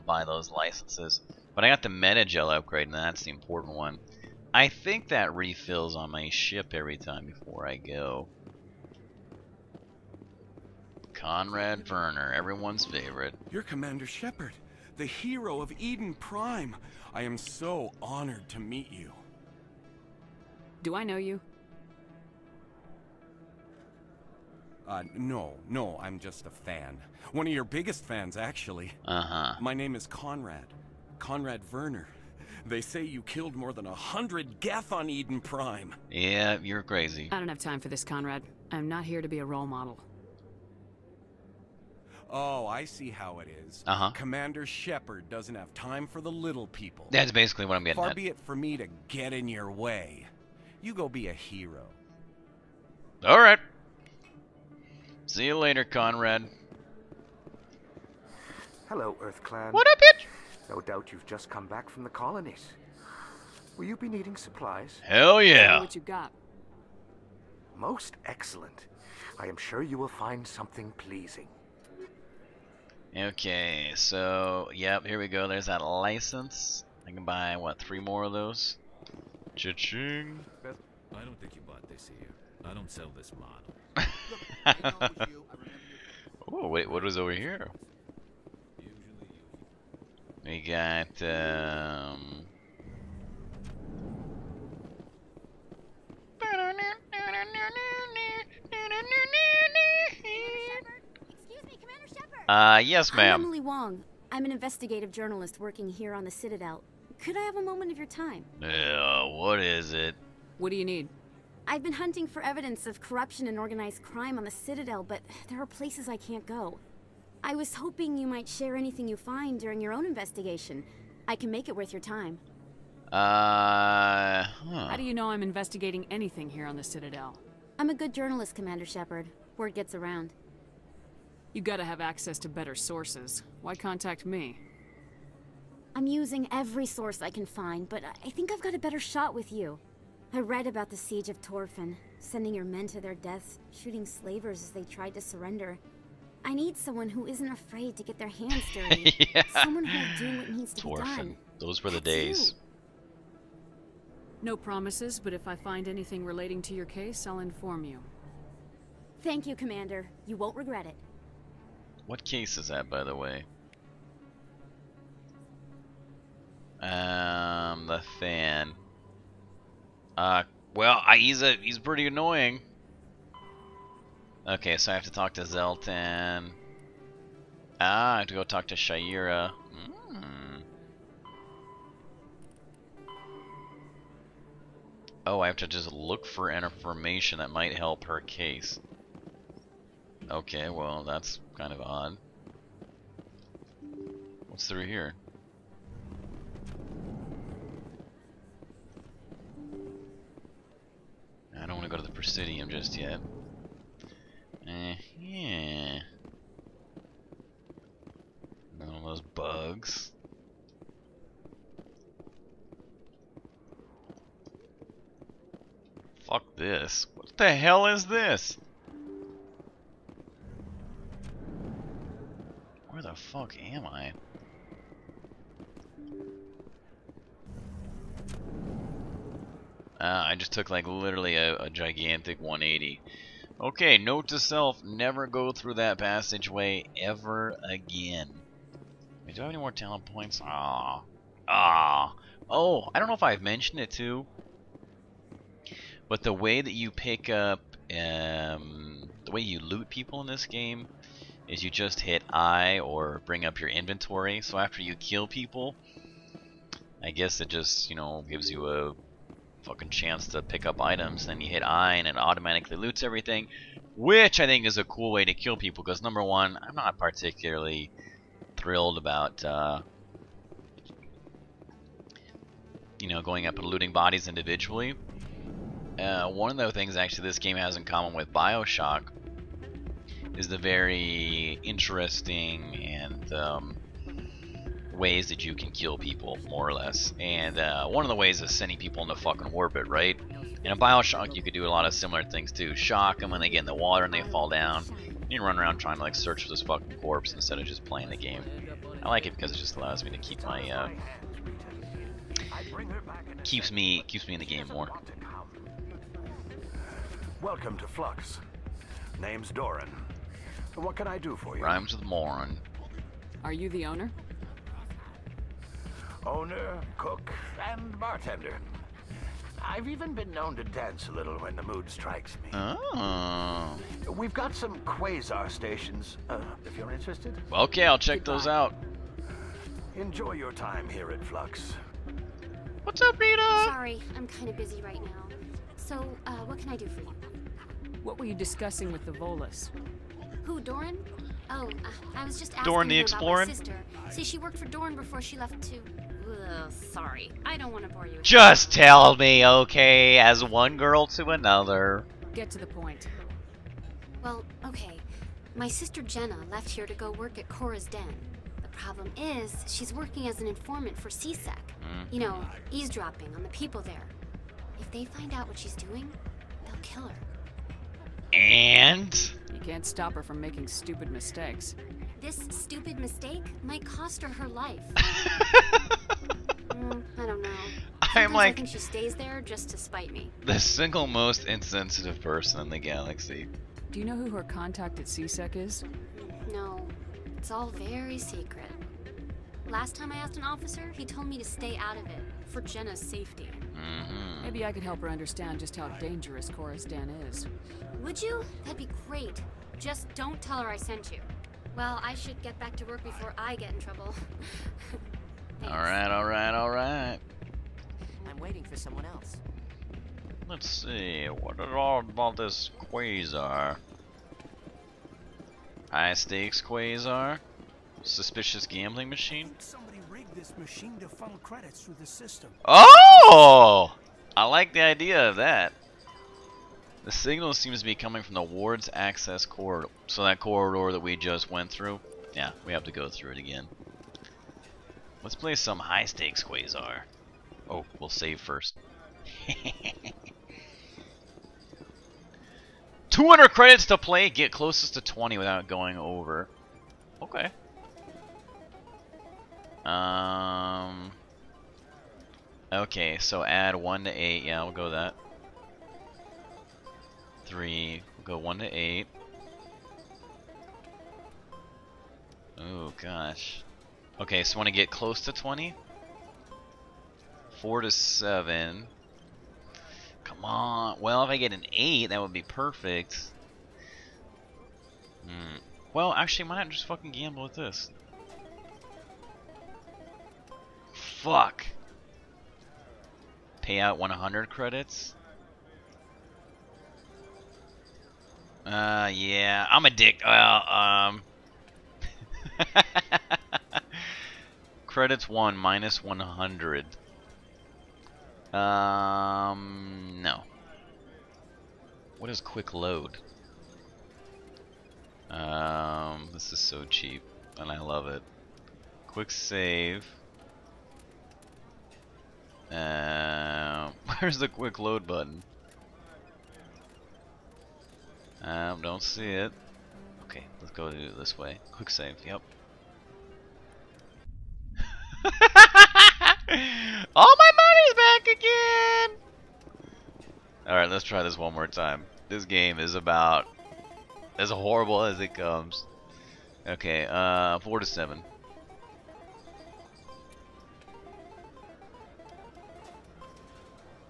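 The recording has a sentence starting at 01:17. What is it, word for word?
I can buy, what, three more of those?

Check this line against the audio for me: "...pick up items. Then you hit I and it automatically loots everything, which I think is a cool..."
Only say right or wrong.
right.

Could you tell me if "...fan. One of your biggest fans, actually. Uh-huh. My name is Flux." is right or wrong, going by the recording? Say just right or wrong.
wrong.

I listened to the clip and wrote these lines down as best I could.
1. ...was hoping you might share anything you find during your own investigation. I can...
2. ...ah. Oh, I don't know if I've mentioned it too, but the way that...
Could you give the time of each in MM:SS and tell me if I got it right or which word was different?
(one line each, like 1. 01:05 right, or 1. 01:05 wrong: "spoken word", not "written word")
1. 01:57 right
2. 04:01 right.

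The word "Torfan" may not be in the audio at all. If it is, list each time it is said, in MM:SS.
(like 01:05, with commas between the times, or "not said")
02:21, 02:30.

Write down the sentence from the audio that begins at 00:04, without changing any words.
I think that refills on my ship every time before I go.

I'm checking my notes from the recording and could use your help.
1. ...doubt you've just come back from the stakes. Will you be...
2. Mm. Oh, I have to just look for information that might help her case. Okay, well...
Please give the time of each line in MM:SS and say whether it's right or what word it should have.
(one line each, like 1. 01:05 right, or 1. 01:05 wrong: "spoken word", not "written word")
1. 01:00 wrong: "colonies", not "stakes"
2. 03:00 right.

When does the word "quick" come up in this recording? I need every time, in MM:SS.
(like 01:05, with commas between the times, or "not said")
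08:22, 08:29, 08:34, 08:41.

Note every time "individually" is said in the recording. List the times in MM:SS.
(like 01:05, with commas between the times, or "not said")
04:34.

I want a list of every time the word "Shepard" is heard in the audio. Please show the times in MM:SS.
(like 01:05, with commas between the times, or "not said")
00:14, 00:44, 02:08.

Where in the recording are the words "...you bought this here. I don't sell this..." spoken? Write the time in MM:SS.
01:21.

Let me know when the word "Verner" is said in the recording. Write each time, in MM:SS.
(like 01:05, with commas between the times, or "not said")
00:11, 00:31.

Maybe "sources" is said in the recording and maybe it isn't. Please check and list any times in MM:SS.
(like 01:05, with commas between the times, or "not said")
02:12, 02:16.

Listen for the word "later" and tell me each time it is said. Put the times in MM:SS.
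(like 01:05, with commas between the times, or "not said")
00:55.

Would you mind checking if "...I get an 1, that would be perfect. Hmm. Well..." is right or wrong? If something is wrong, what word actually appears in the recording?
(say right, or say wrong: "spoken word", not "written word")
wrong: "8", not "1".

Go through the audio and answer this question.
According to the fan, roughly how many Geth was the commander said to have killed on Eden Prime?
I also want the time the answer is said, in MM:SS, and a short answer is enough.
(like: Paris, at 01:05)
100, at 00:33.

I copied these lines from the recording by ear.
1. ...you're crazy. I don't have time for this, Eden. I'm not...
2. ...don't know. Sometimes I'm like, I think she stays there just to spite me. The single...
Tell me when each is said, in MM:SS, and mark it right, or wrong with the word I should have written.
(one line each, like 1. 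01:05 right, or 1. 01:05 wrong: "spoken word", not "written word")
1. 00:36 wrong: "Conrad", not "Eden"
2. 06:17 right.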